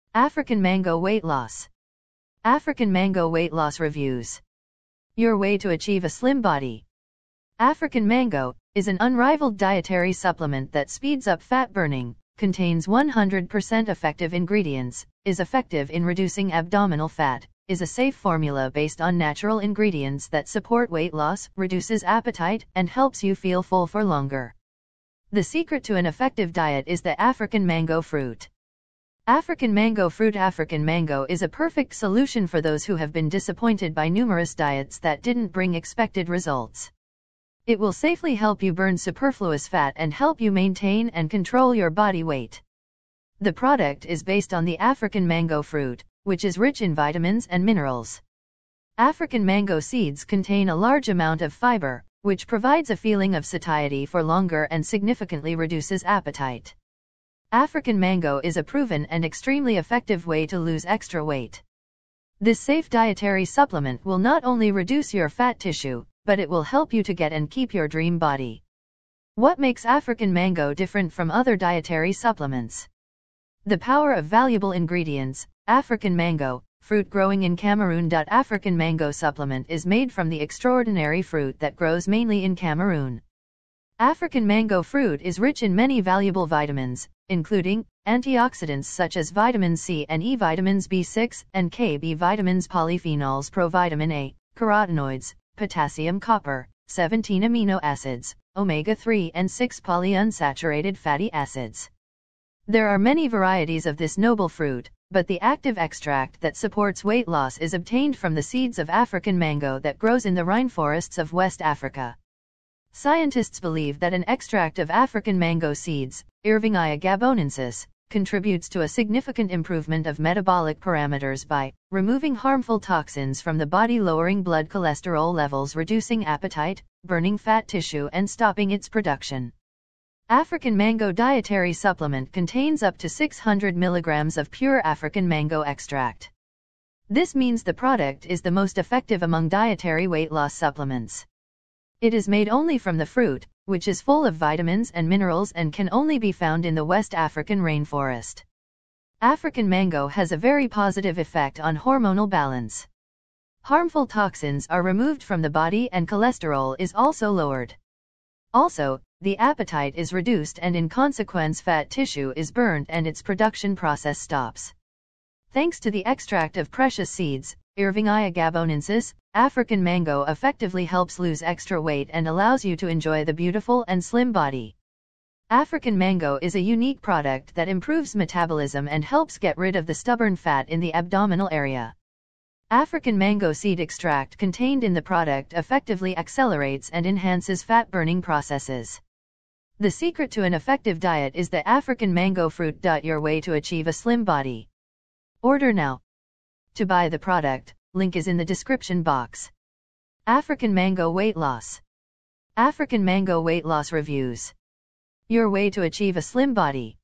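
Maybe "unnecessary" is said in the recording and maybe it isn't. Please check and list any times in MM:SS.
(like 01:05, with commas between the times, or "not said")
not said.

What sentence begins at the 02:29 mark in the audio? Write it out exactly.
African mango has a very positive effect on hormonal balance.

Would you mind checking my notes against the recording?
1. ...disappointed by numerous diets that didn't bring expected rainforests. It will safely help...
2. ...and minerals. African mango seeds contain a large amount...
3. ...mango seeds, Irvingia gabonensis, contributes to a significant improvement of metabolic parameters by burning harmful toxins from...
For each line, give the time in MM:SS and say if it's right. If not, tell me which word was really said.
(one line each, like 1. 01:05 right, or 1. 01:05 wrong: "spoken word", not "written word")
1. 00:33 wrong: "results", not "rainforests"
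2. 00:47 right
3. 01:55 wrong: "removing", not "burning".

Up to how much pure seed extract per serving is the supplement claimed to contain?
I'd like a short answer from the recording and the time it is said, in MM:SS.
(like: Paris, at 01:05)
600 milligrams, at 02:13.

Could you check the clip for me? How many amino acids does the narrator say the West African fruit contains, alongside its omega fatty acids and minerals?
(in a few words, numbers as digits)
17.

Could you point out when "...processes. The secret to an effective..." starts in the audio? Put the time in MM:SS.
03:08.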